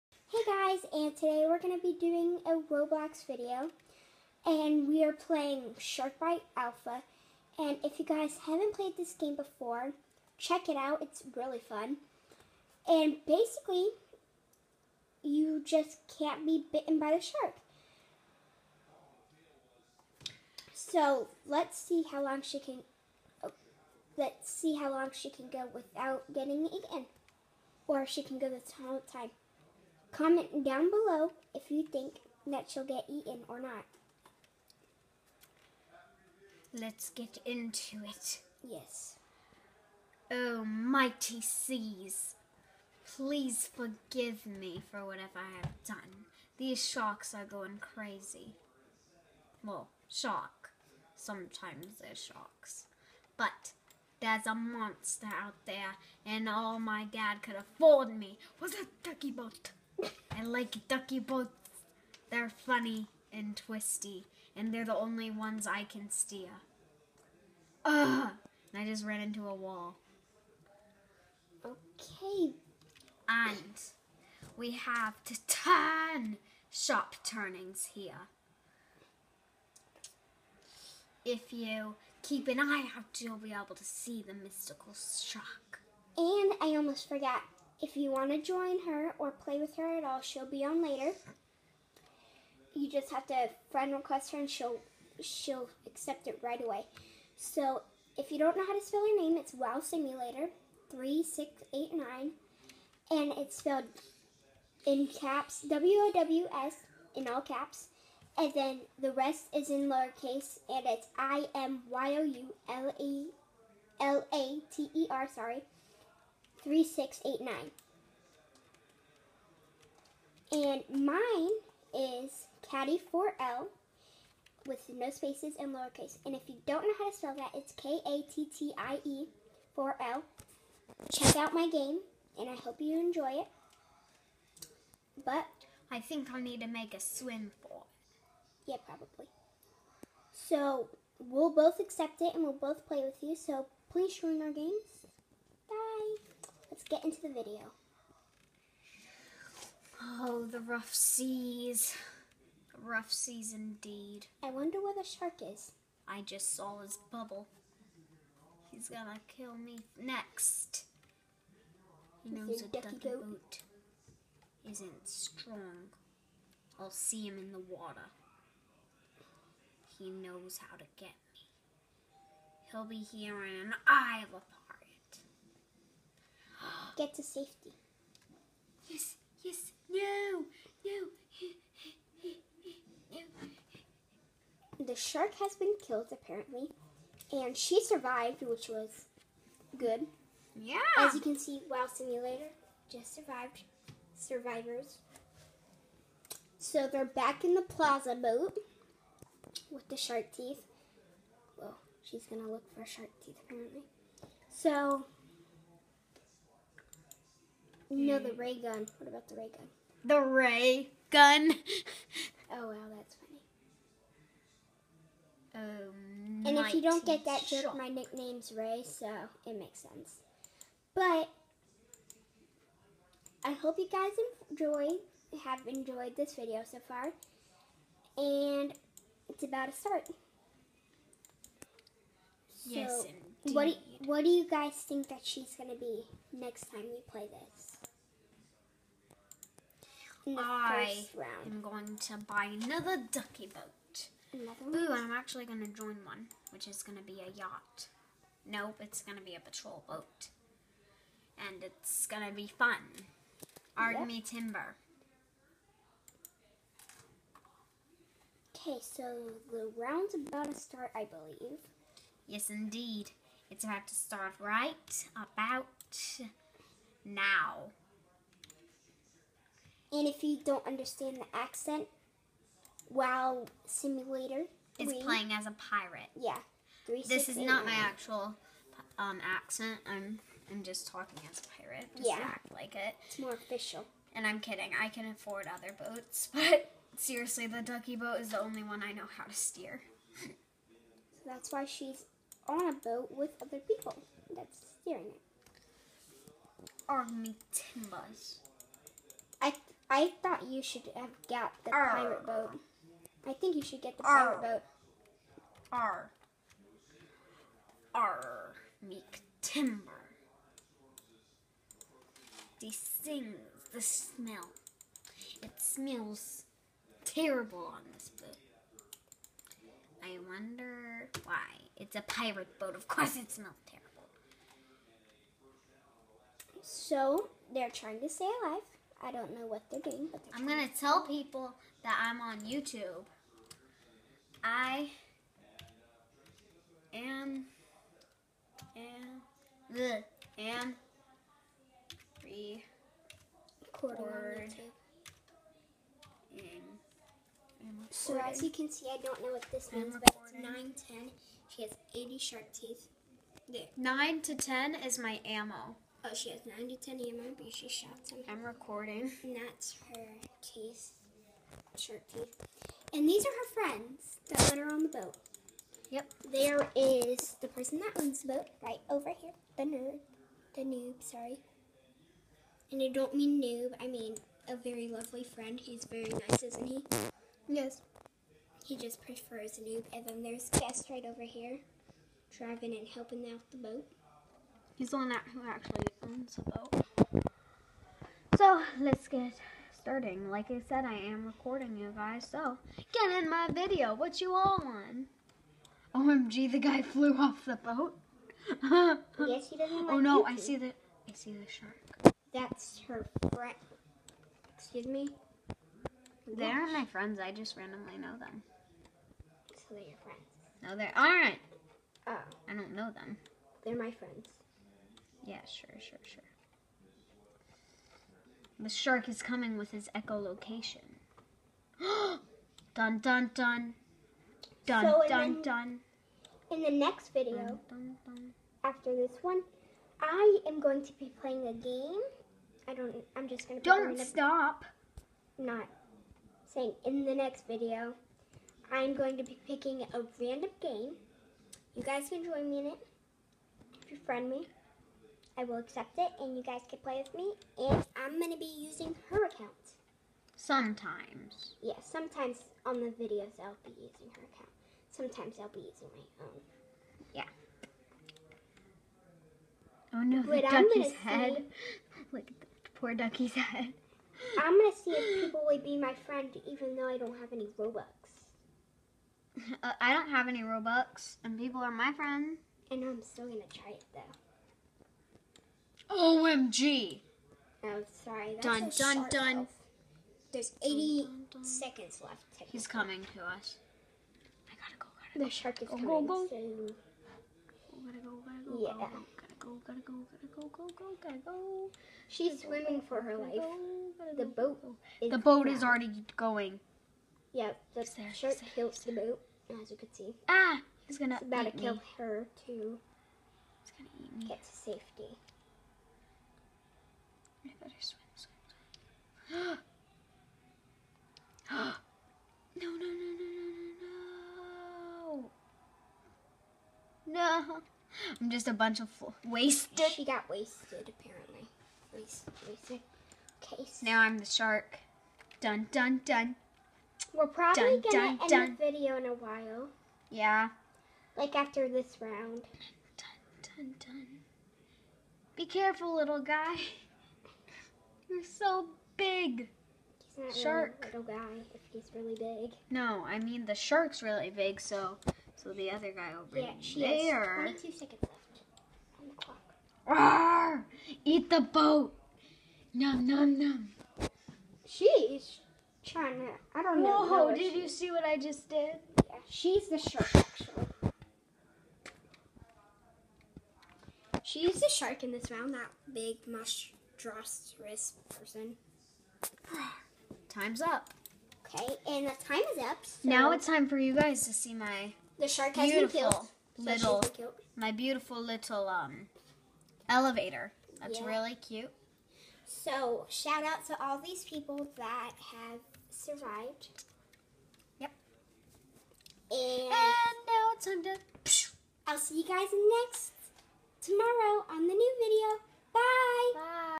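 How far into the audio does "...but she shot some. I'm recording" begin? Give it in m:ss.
5:57.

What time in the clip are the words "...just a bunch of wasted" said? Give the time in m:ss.
8:38.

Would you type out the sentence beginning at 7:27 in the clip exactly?
And I'm going to be using her account.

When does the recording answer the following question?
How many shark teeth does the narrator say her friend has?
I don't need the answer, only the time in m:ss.
5:51.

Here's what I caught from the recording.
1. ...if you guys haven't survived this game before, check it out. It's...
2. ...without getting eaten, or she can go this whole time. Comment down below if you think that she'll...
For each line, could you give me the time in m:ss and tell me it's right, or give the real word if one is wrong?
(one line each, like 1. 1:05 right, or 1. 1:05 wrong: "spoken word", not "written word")
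1. 0:07 wrong: "played", not "survived"
2. 0:25 right.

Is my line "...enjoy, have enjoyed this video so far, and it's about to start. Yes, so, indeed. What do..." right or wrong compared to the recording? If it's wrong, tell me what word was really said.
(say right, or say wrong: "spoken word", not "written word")
right.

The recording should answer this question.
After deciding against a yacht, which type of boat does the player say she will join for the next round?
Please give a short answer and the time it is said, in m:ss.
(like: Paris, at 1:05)
Patrol boat, at 4:09.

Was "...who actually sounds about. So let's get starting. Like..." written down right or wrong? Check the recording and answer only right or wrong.
right.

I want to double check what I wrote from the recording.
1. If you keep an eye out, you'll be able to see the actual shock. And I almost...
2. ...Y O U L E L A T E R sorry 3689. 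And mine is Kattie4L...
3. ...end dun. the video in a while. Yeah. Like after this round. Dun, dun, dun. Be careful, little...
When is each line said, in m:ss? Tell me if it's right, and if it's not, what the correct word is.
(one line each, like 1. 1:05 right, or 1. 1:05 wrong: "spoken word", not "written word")
1. 1:21 wrong: "mystical", not "actual"
2. 1:51 right
3. 8:48 right.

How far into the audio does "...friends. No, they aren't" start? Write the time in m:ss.
6:50.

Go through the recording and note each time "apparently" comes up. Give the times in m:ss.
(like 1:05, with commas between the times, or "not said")
3:06, 3:23, 8:40.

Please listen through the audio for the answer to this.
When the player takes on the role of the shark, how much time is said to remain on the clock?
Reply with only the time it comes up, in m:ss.
9:07.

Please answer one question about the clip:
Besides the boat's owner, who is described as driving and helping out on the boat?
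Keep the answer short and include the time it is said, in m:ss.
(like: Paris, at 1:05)
Guest, at 6:20.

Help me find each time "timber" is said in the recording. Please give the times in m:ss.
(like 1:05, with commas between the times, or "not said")
4:14, 4:57, 5:09.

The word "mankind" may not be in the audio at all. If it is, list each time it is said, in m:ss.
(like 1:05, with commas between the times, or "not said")
not said.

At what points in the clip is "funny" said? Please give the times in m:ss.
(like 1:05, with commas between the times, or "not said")
1:02, 3:35.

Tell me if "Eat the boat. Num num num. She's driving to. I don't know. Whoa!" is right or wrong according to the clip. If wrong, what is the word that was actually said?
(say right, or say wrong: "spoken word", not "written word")
wrong: "trying", not "driving".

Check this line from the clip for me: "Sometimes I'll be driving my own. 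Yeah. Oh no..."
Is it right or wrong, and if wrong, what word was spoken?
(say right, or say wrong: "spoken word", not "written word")
wrong: "using", not "driving".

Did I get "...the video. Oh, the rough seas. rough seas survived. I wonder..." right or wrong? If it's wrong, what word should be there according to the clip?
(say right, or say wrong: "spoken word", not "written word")
wrong: "indeed", not "survived".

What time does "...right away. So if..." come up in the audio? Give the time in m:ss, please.
1:36.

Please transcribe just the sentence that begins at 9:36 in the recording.
Little, my beautiful little um elevator.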